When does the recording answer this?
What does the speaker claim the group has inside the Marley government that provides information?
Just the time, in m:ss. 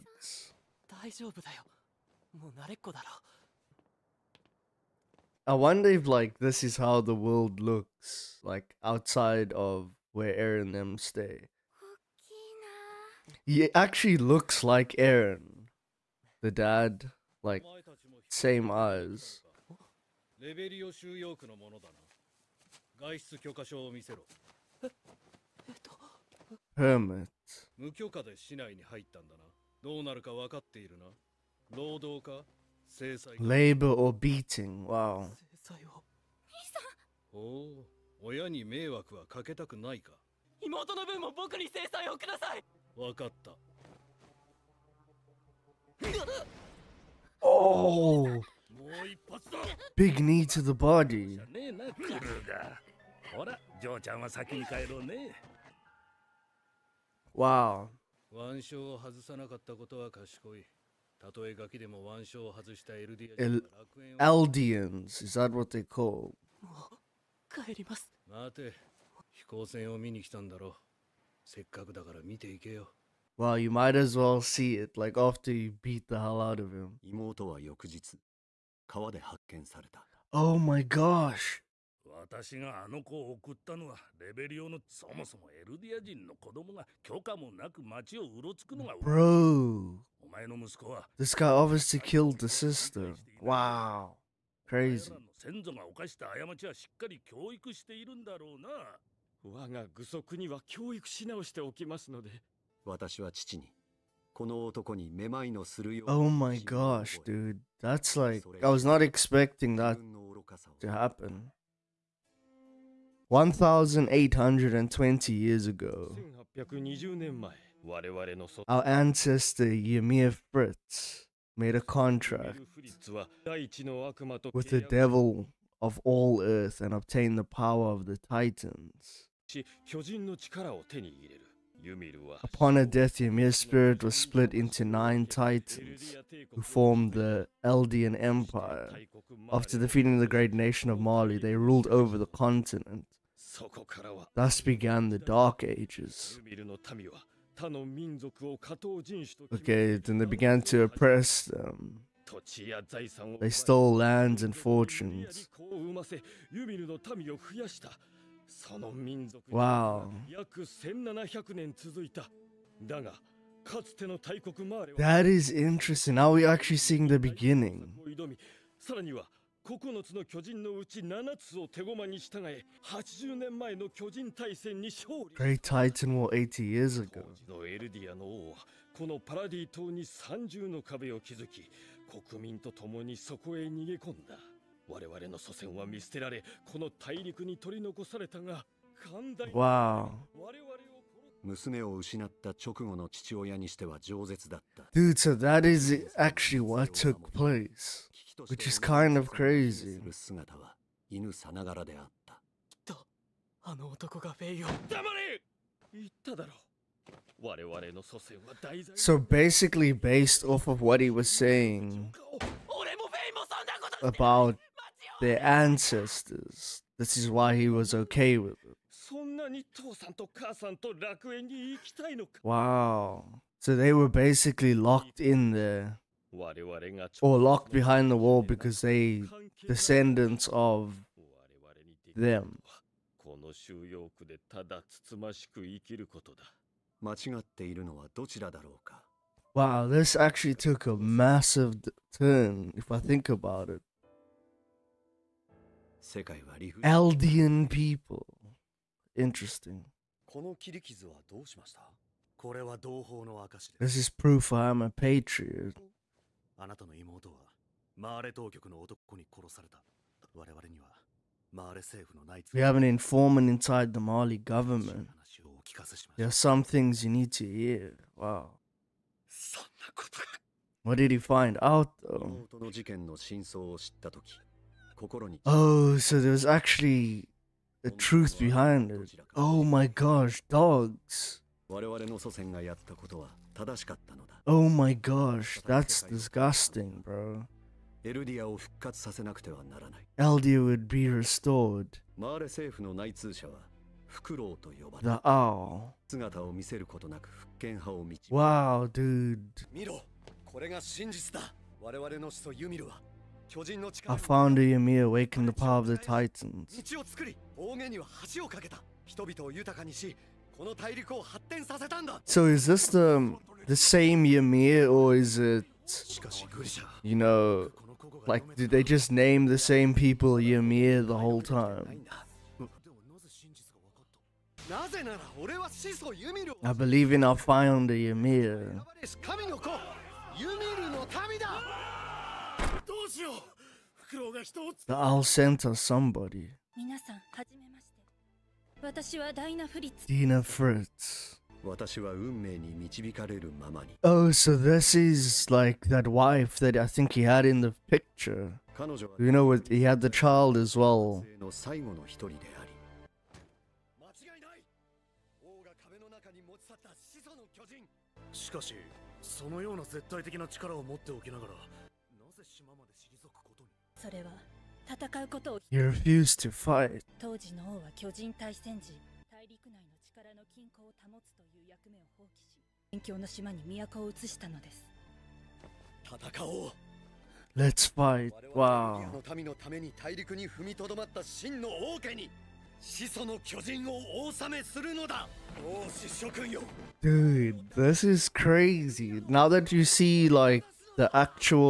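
4:22.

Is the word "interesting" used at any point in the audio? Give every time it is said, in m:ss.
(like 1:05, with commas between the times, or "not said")
2:45, 4:09.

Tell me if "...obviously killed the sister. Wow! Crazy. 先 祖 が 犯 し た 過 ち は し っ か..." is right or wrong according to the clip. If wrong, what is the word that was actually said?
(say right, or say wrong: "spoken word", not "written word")
right.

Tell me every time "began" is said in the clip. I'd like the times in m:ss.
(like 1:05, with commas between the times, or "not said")
2:24, 2:30.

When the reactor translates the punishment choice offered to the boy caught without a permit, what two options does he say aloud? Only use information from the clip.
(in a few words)
Labor or beating.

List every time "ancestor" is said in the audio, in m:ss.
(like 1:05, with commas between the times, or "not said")
1:58, 3:35.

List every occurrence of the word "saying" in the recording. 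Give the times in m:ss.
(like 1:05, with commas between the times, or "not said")
3:31.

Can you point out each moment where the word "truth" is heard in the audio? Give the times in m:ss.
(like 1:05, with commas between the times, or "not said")
4:37.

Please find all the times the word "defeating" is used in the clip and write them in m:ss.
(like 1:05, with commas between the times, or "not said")
2:19.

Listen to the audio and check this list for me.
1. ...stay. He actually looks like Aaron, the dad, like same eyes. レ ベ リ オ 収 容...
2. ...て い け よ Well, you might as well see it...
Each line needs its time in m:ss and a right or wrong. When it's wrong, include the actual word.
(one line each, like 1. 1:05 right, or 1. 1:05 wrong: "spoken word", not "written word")
1. 0:10 right
2. 1:12 right.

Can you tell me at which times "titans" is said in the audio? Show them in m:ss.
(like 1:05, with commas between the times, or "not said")
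2:08, 2:15, 2:55, 5:05.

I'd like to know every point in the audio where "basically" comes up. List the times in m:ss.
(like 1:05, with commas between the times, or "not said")
3:29, 3:44.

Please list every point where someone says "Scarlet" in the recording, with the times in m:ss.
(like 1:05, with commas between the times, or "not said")
not said.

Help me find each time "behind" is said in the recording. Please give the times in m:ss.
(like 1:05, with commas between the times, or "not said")
3:47, 4:38.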